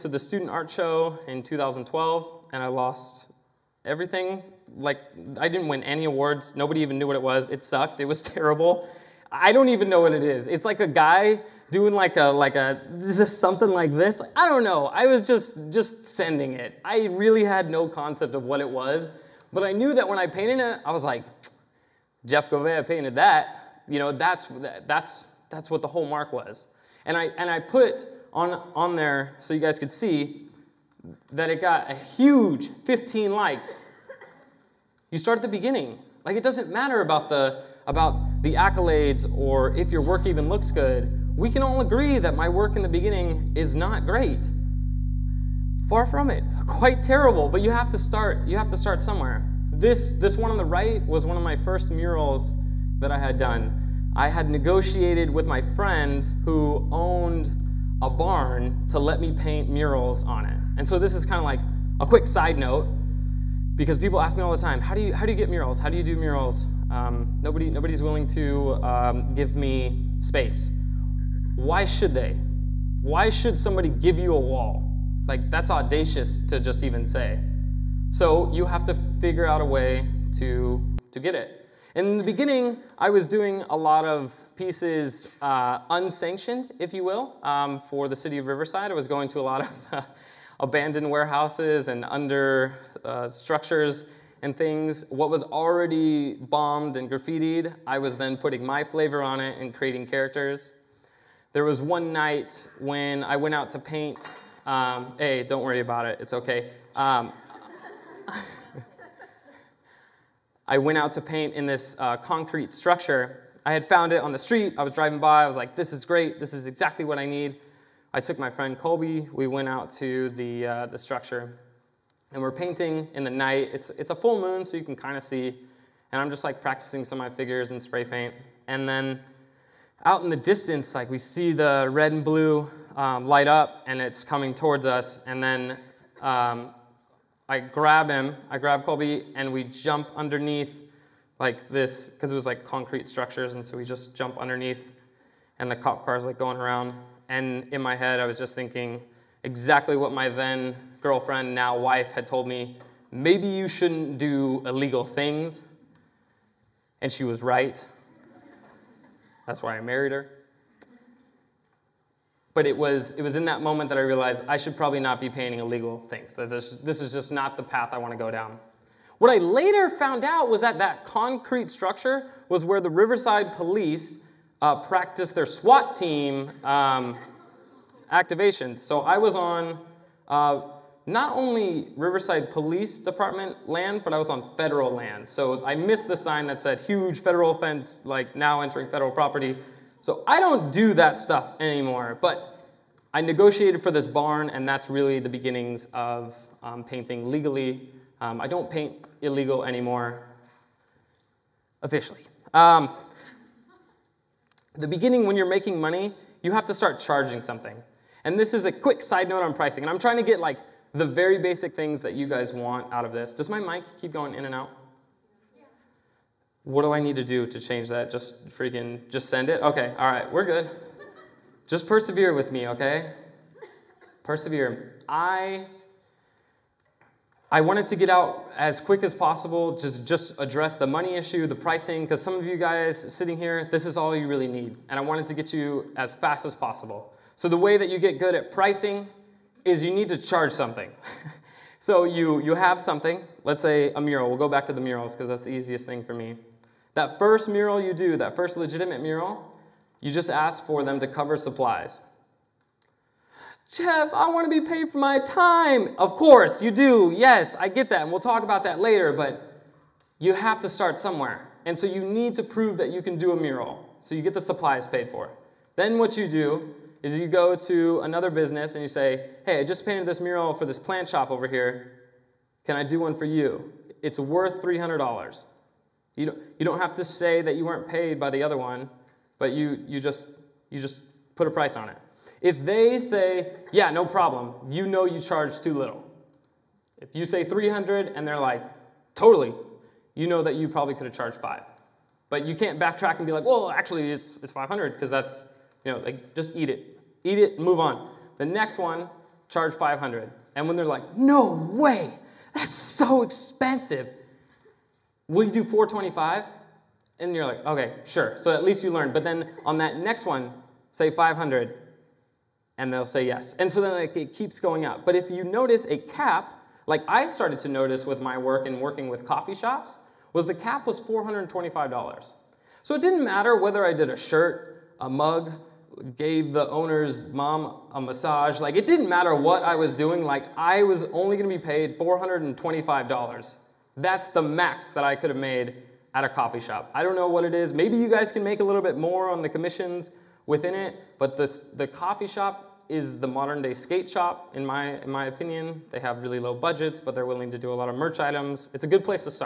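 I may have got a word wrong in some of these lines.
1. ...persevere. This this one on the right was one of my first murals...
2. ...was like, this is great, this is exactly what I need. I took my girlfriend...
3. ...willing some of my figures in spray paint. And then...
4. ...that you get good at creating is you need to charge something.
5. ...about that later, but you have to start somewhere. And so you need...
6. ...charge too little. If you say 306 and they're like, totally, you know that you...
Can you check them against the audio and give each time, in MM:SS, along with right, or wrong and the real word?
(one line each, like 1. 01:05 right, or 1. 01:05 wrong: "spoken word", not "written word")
1. 00:49 wrong: "somewhere", not "persevere"
2. 01:55 wrong: "friend", not "girlfriend"
3. 02:06 wrong: "practicing", not "willing"
4. 03:57 wrong: "pricing", not "creating"
5. 04:18 right
6. 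04:45 wrong: "300", not "306".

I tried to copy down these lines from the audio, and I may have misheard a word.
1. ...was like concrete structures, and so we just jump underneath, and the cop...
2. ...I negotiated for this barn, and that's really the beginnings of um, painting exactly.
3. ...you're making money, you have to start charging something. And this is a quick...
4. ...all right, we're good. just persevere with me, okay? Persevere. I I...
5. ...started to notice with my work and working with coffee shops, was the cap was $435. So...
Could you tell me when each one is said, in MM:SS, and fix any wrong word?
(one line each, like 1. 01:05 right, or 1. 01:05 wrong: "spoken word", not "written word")
1. 02:22 right
2. 03:13 wrong: "legally", not "exactly"
3. 03:25 right
4. 03:39 right
5. 05:17 wrong: "425", not "435".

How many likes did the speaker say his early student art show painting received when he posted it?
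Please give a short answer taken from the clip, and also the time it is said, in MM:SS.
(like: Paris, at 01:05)
15, at 00:32.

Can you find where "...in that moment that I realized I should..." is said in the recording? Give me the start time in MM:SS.
02:43.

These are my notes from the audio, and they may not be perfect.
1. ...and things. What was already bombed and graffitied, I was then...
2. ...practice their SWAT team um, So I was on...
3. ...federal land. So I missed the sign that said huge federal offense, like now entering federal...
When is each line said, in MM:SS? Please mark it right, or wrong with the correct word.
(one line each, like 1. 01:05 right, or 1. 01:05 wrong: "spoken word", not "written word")
1. 01:34 right
2. 02:54 right
3. 03:04 right.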